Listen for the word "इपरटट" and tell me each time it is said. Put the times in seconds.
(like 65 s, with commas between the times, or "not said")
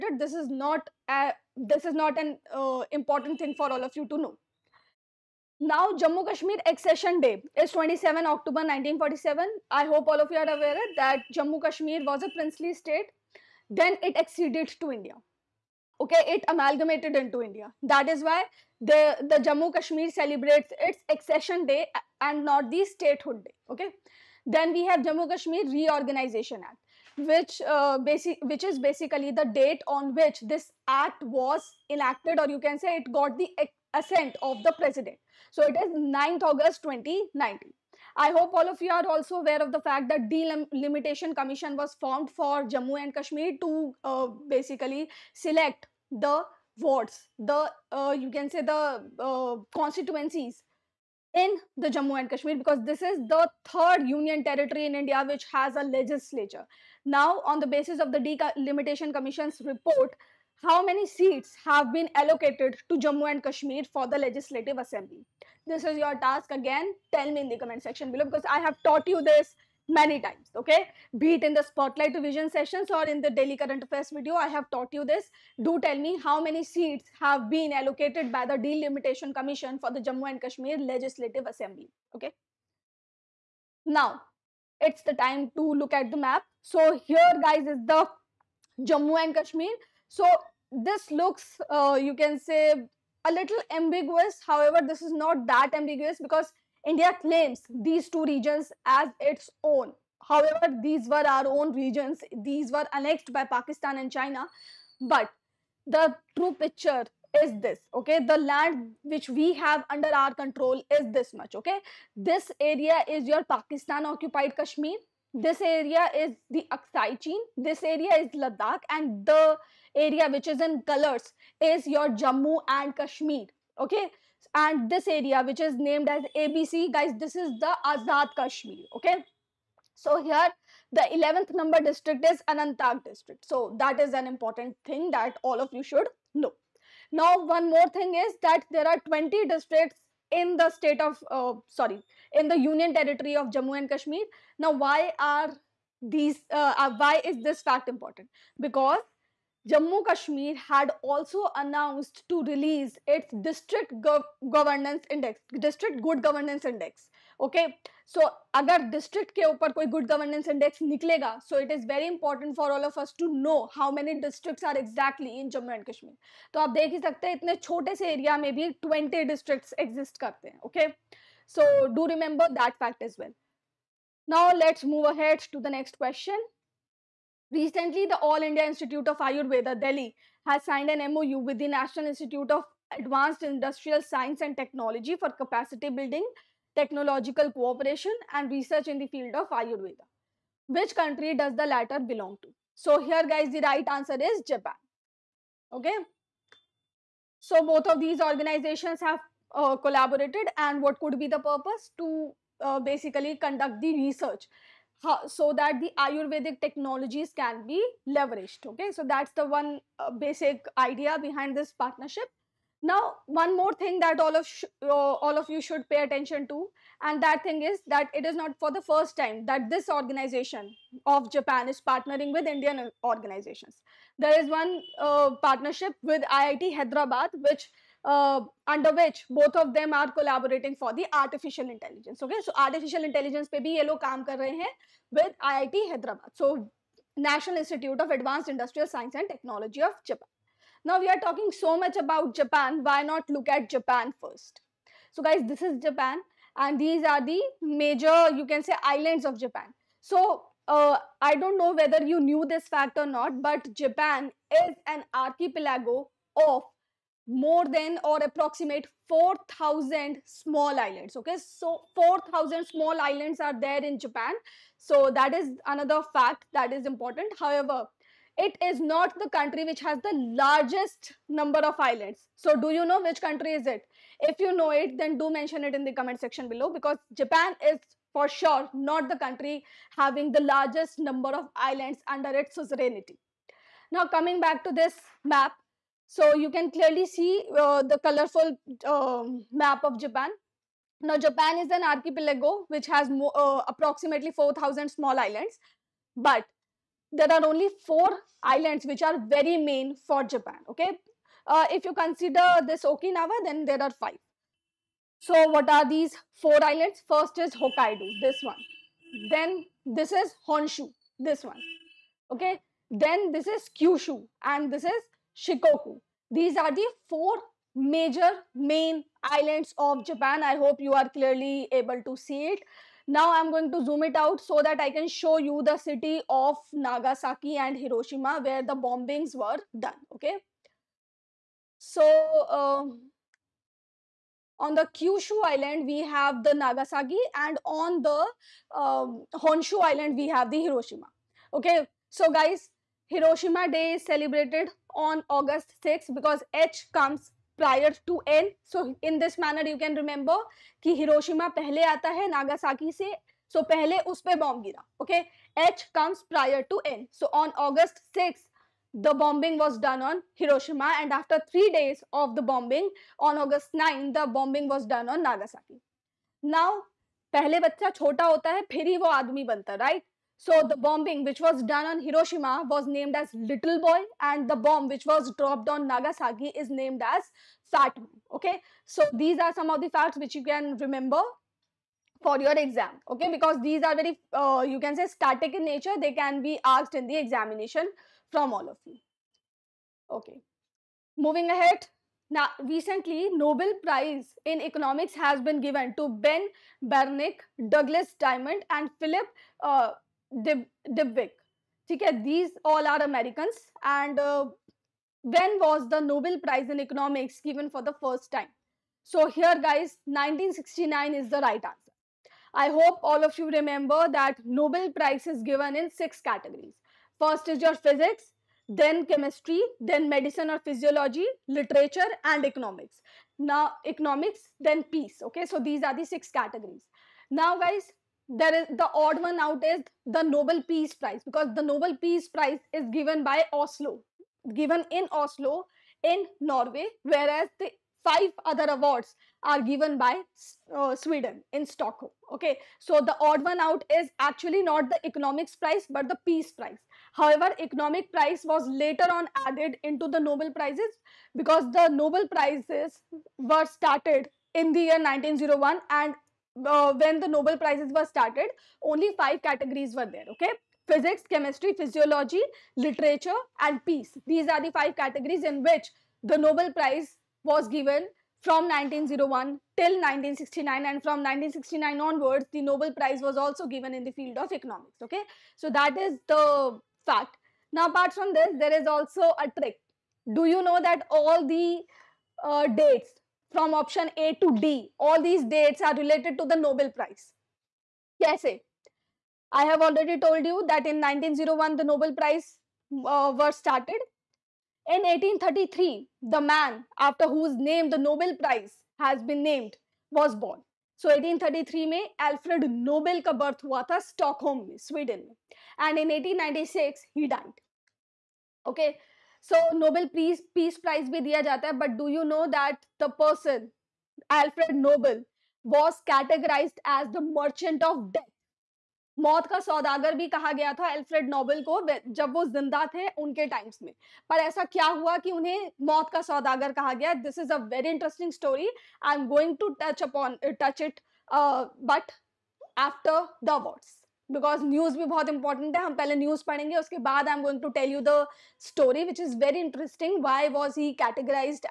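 535 s.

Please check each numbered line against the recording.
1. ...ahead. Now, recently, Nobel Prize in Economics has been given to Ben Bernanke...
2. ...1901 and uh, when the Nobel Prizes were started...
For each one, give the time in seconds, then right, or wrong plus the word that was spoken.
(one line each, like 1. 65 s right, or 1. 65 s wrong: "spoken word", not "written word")
1. 391 s right
2. 455 s right.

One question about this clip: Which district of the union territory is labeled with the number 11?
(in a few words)
Anantnag.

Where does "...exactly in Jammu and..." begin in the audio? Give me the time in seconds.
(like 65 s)
164 s.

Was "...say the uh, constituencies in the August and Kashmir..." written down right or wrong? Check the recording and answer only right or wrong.
wrong.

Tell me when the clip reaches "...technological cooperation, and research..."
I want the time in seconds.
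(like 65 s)
186 s.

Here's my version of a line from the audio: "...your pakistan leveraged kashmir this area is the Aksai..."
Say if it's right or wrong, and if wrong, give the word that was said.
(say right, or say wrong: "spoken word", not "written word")
wrong: "occupied", not "leveraged".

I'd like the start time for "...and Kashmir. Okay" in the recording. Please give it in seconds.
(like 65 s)
122 s.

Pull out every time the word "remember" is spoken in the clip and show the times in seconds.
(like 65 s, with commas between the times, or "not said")
172 s, 349 s, 380 s, 413 s.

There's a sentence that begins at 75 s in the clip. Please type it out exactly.
Do tell me how many seats have been allocated by the Delimitation Commission for the Jammu and Kashmir Legislative Assembly, okay?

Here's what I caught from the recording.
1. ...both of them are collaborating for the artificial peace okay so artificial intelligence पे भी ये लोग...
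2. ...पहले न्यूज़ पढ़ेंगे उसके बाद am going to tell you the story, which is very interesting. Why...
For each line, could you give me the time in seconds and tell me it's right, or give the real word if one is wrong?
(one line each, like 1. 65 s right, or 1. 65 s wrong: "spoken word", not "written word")
1. 229 s wrong: "intelligence", not "peace"
2. 535 s right.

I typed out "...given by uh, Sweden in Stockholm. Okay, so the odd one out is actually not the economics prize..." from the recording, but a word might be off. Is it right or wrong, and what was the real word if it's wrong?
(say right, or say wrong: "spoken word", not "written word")
right.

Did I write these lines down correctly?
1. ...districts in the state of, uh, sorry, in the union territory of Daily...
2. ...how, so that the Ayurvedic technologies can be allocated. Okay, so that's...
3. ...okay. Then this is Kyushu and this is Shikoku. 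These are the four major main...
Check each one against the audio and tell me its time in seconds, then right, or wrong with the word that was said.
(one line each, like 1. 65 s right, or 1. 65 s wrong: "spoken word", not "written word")
1. 139 s wrong: "Jammu", not "Daily"
2. 205 s wrong: "leveraged", not "allocated"
3. 312 s right.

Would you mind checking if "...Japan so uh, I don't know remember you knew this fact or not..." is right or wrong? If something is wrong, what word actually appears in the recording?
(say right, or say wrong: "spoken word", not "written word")
wrong: "whether", not "remember".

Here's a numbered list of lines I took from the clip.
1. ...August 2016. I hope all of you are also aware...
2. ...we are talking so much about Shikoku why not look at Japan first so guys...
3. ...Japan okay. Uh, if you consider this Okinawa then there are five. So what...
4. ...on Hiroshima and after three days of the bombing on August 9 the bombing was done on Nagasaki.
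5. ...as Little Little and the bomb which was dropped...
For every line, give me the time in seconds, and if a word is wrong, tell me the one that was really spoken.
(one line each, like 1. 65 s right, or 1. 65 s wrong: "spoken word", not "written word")
1. 36 s wrong: "2019", not "2016"
2. 240 s wrong: "Japan", not "Shikoku"
3. 300 s right
4. 360 s right
5. 373 s wrong: "Boy", not "Little".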